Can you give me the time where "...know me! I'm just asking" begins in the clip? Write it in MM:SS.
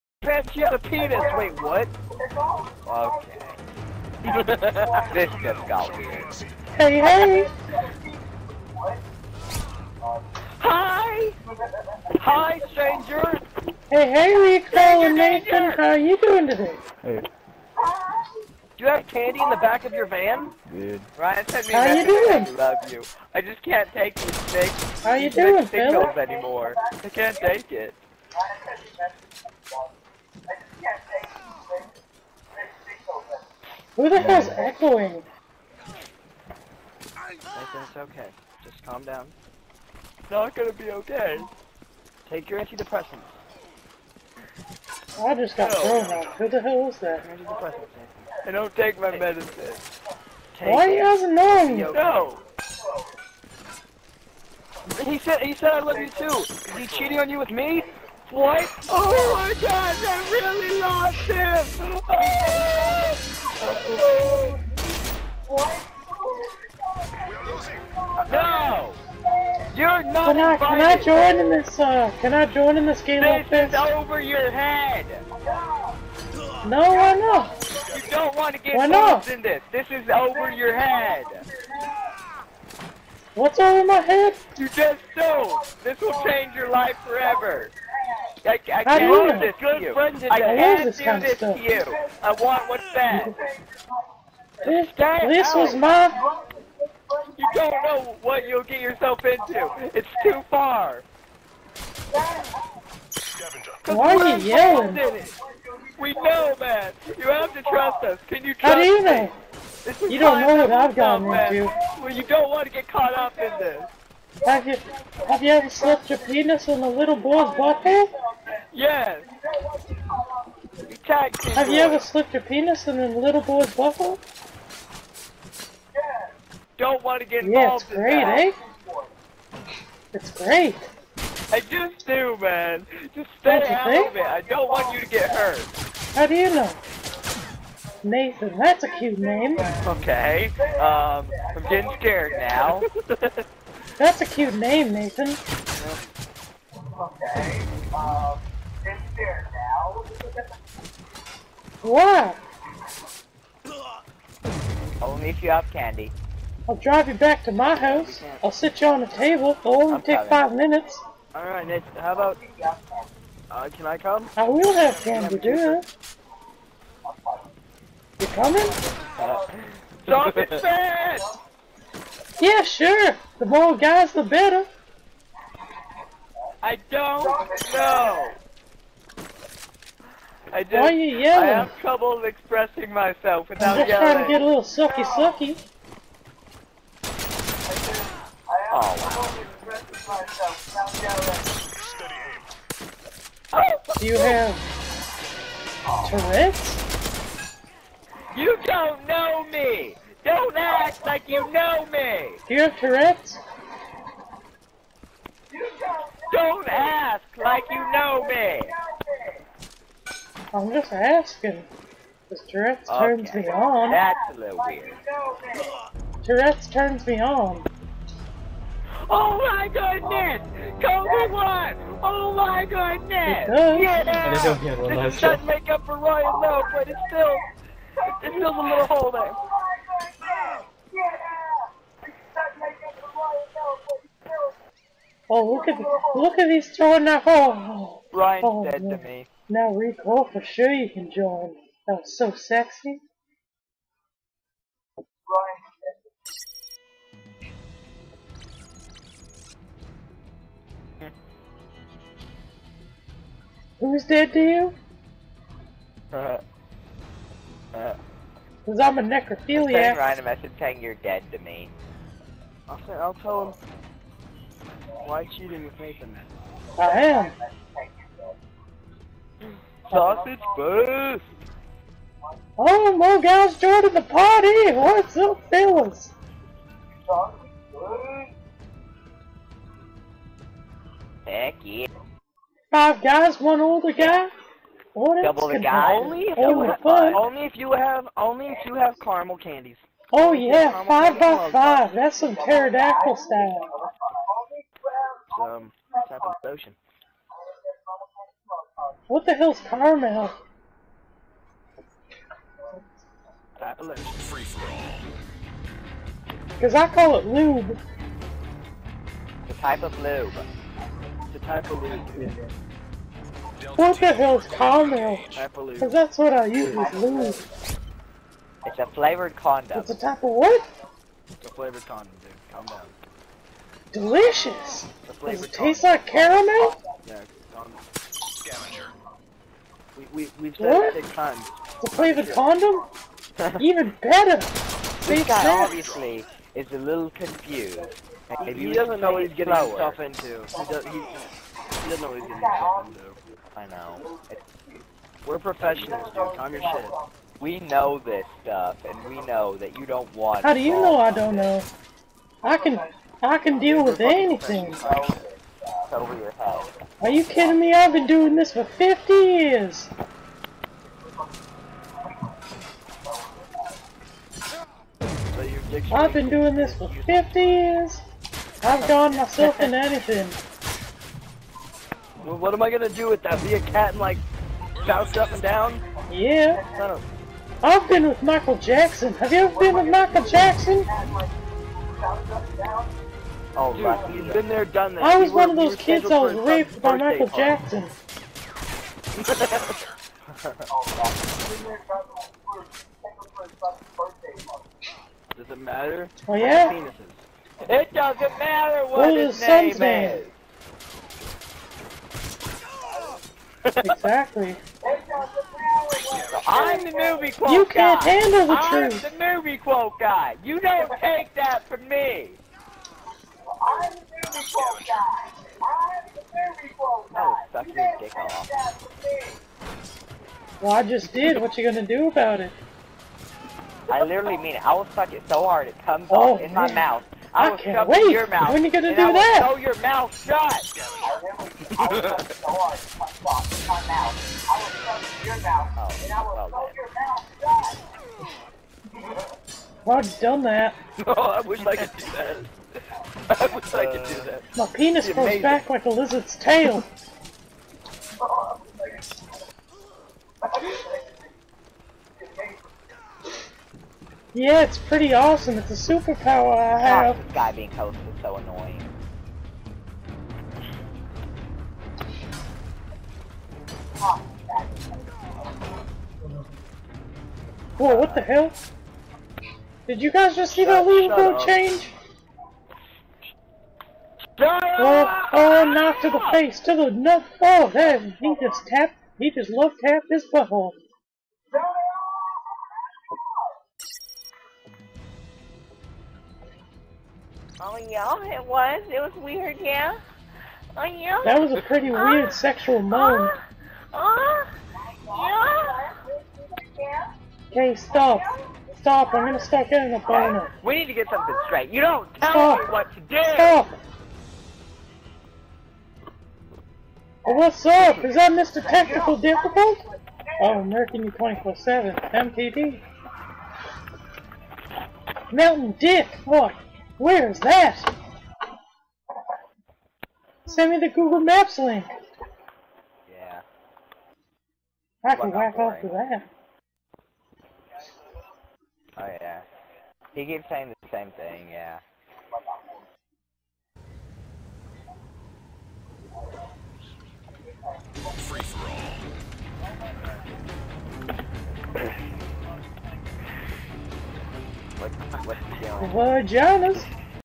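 03:27.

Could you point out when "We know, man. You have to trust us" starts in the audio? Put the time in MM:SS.
01:45.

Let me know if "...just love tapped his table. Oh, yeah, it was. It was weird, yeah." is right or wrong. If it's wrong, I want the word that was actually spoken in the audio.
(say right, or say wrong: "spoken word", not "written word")
wrong: "butthole", not "table".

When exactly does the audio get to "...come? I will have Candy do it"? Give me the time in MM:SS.
02:43.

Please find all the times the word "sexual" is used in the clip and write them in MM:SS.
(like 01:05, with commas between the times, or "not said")
08:12.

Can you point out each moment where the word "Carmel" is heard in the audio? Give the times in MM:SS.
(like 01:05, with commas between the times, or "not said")
04:59, 05:14.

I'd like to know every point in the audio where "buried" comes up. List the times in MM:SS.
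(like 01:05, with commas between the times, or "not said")
not said.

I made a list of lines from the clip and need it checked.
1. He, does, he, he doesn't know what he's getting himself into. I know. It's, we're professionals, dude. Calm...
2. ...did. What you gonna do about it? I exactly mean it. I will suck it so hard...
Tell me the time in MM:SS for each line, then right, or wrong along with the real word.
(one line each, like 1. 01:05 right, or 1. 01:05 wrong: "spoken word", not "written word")
1. 05:40 right
2. 07:01 wrong: "literally", not "exactly".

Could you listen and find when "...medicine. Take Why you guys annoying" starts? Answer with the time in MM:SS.
00:49.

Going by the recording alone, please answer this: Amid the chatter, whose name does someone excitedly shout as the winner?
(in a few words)
Kobe.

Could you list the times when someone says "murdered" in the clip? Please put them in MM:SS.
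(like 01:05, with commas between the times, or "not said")
not said.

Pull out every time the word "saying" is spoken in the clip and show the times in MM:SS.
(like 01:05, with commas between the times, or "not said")
04:20, 08:50.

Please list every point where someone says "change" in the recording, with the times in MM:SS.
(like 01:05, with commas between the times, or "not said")
01:26, 07:51.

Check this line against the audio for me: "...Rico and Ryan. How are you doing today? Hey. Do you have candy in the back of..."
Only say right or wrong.
wrong.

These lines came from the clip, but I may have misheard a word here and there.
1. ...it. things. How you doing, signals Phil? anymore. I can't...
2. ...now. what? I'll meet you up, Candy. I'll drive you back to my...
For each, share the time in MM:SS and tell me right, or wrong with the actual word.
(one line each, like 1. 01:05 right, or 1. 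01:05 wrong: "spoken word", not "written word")
1. 00:24 right
2. 02:29 right.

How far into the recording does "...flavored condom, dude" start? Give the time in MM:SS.
05:21.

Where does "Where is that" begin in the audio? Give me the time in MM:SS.
08:36.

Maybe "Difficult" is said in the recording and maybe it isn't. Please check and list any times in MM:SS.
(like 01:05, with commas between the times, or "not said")
08:29.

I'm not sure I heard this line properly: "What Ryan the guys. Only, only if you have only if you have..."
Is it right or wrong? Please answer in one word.
wrong.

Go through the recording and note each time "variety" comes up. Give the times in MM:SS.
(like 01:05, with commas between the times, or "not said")
not said.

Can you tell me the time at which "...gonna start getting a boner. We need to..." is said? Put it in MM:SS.
08:19.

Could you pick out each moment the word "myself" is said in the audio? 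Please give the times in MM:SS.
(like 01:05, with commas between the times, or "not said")
03:02, 06:09.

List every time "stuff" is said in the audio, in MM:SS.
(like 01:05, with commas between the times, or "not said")
05:48.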